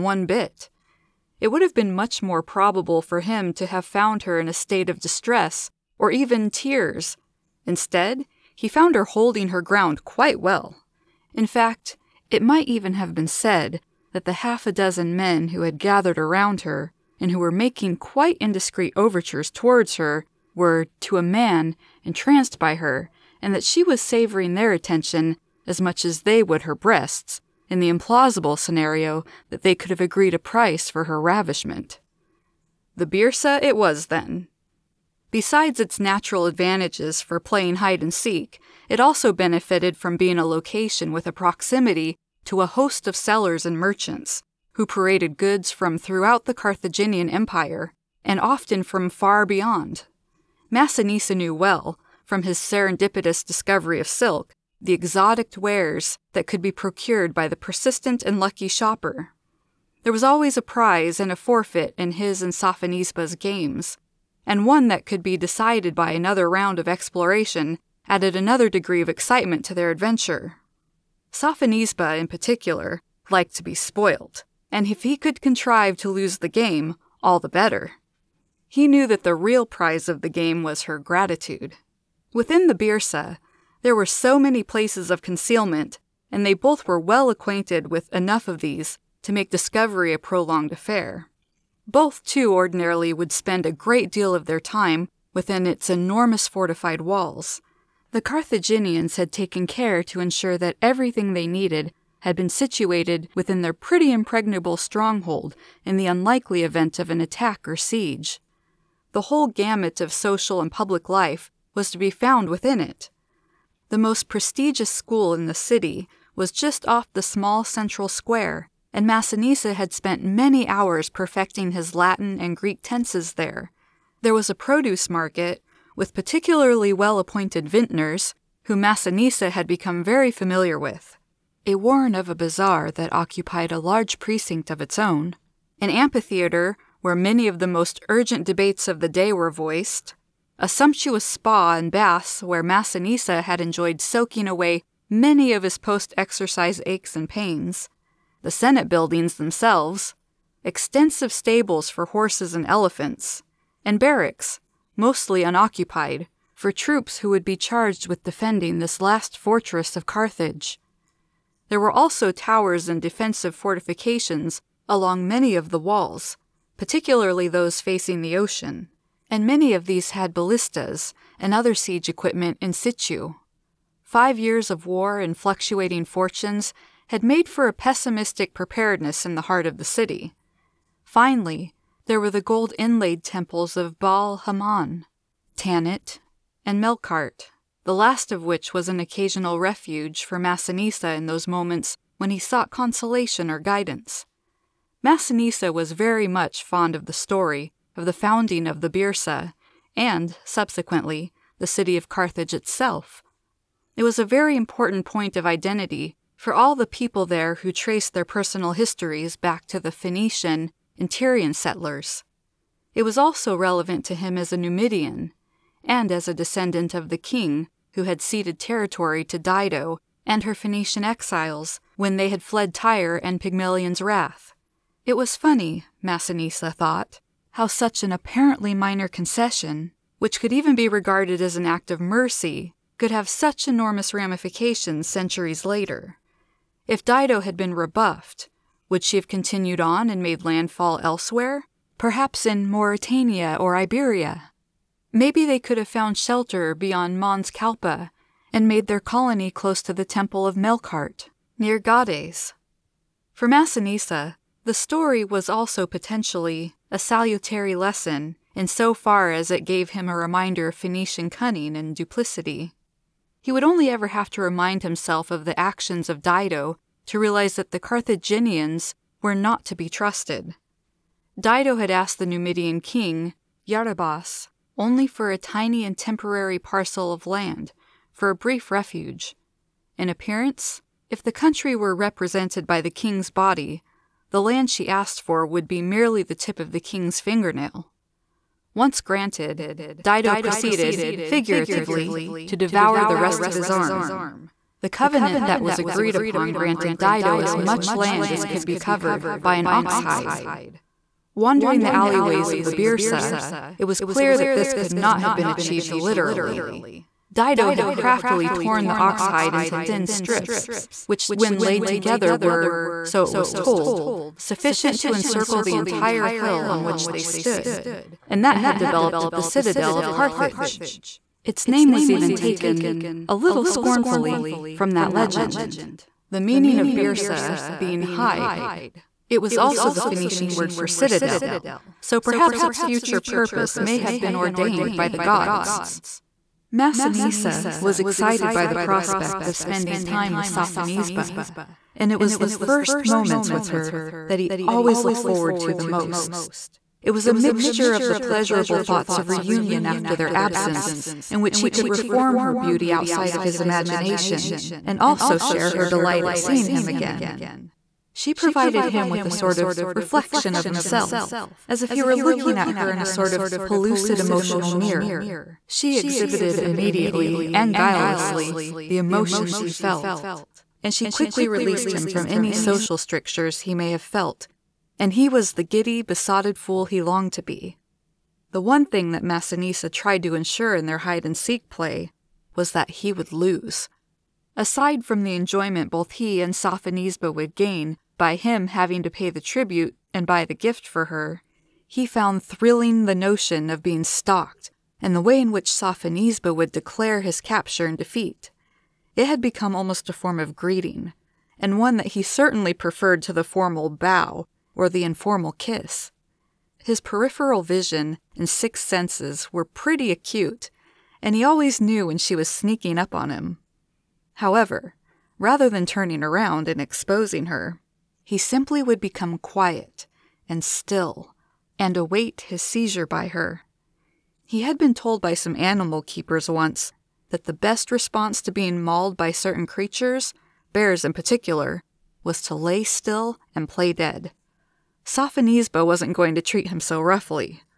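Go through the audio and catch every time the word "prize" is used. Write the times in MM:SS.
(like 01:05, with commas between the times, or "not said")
01:00, 01:19.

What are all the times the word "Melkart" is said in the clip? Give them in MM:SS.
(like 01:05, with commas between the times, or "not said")
03:06, 04:10.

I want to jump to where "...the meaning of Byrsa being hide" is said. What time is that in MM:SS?
05:26.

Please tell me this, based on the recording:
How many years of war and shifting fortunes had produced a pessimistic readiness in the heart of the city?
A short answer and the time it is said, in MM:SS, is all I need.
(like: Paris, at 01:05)
5, at 02:54.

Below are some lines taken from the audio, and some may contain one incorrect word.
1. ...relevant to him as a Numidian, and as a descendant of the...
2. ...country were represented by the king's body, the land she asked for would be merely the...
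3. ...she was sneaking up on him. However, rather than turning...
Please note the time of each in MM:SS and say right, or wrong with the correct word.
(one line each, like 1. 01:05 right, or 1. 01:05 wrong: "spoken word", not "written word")
1. 03:33 right
2. 04:41 right
3. 06:52 right.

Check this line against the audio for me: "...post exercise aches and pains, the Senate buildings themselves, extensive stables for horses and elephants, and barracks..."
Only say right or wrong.
right.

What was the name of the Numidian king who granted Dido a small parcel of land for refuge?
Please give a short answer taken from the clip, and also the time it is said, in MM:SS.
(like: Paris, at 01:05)
Yarabas, at 04:33.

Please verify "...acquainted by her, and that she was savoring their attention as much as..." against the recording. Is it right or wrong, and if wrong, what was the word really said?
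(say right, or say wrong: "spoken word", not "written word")
wrong: "entranced", not "acquainted".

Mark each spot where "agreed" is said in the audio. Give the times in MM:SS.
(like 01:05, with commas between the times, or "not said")
00:29, 04:55.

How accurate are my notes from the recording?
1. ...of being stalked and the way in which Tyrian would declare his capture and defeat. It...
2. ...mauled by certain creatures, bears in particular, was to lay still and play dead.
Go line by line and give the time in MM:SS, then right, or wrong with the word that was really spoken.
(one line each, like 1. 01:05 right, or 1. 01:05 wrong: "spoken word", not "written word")
1. 06:33 wrong: "Sophonisba", not "Tyrian"
2. 07:08 right.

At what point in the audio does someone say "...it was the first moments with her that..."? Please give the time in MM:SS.
05:42.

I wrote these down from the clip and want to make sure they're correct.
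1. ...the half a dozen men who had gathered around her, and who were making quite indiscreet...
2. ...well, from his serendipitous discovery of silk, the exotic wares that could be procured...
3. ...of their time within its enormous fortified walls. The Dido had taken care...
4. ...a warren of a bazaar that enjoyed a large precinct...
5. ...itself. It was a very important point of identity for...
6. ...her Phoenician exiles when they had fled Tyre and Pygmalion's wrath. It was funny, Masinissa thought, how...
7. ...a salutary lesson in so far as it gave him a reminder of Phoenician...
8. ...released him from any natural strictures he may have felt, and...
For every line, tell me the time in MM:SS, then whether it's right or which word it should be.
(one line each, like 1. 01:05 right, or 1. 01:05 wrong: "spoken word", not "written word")
1. 00:14 right
2. 00:51 right
3. 01:34 wrong: "Carthaginians", not "Dido"
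4. 02:11 wrong: "occupied", not "enjoyed"
5. 03:22 right
6. 03:40 right
7. 04:16 right
8. 06:11 wrong: "social", not "natural".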